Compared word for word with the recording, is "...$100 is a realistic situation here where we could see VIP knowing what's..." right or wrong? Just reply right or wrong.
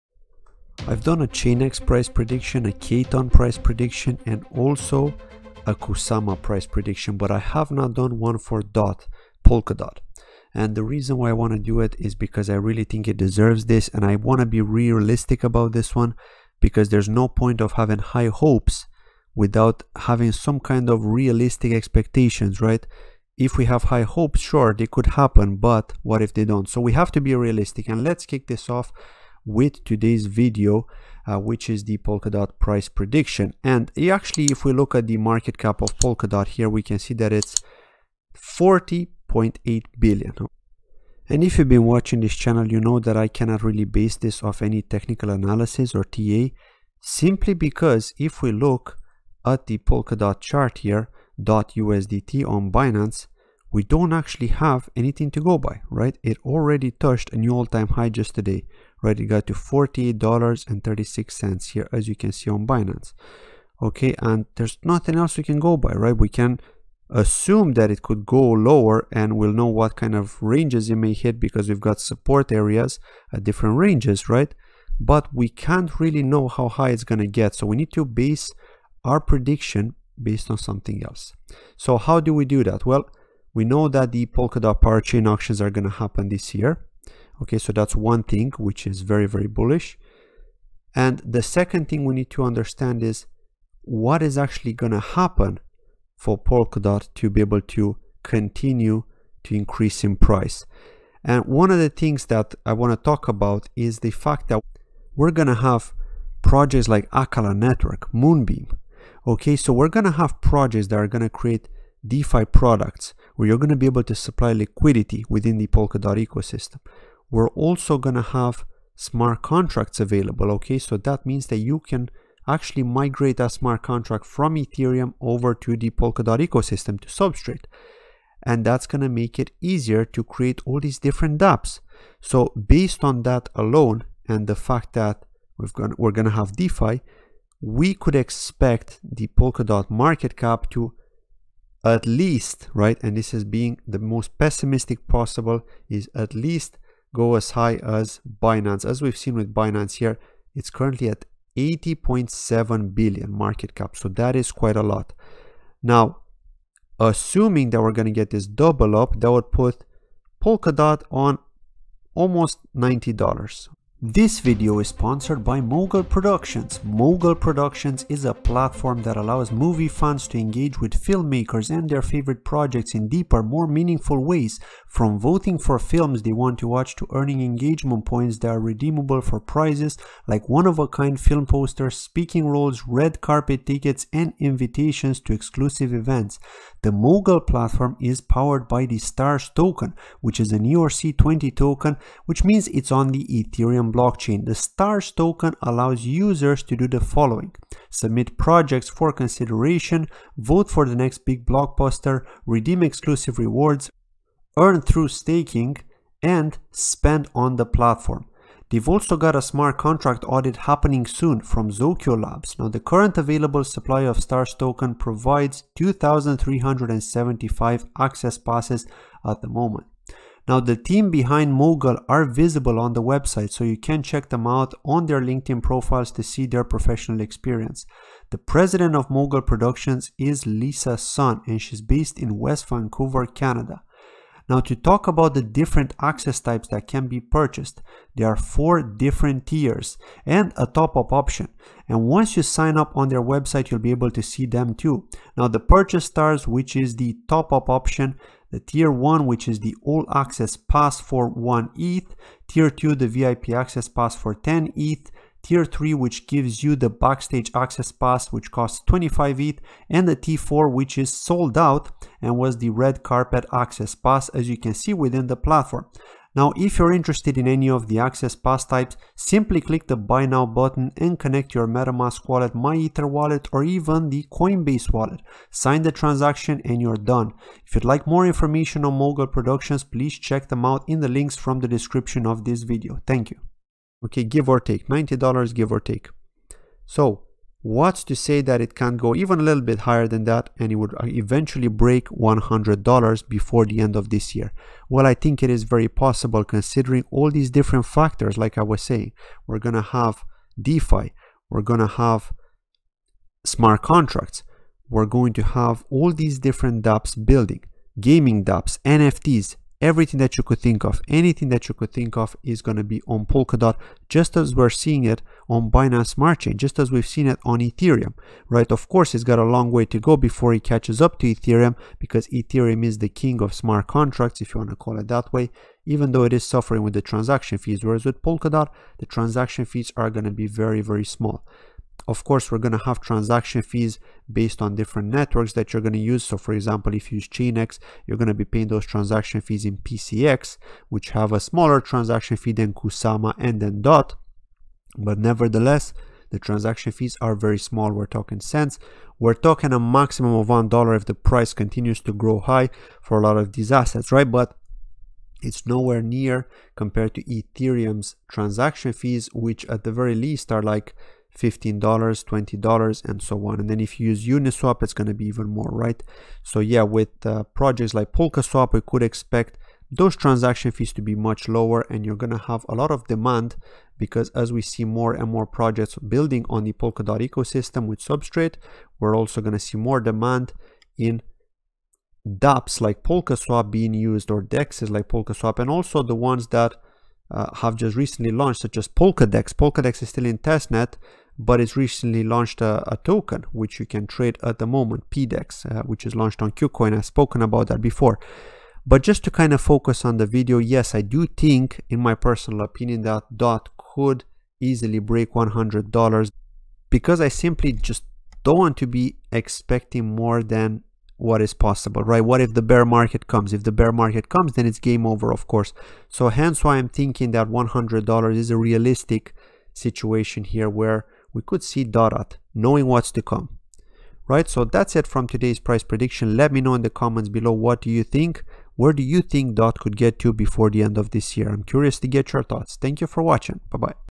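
wrong.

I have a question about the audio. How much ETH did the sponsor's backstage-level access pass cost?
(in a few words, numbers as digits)
25 ETH.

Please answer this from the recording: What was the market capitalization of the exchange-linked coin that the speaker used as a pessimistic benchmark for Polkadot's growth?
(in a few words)
80.7 billion.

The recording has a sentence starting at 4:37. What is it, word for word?
If you'd like more information on Mogul Productions, please check them out in the links from the description of this video.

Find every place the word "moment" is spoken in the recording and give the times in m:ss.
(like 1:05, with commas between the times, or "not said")
3:39, 6:34.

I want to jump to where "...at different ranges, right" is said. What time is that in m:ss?
1:13.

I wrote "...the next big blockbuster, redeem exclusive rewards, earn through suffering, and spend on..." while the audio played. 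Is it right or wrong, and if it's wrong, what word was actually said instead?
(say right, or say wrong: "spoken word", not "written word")
wrong: "staking", not "suffering".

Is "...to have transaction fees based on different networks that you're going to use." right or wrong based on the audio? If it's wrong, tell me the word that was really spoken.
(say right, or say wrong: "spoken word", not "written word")
right.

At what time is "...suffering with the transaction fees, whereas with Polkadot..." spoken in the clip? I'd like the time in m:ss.
5:26.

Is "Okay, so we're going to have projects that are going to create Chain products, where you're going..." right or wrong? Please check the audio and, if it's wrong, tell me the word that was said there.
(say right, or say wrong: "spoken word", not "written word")
wrong: "DeFi", not "Chain".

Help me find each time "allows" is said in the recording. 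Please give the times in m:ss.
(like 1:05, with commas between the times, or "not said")
2:49, 3:15.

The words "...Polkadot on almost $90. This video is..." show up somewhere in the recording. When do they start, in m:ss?
2:40.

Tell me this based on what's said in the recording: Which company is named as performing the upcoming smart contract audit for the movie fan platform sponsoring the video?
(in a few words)
Zokyo Labs.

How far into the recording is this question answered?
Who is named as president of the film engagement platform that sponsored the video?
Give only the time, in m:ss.
3:50.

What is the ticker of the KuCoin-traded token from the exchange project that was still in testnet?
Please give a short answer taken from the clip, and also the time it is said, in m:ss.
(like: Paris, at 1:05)
PDEX, at 6:35.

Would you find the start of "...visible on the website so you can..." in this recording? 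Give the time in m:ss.
3:42.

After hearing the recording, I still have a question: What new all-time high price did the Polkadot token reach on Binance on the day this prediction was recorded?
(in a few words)
$48.36.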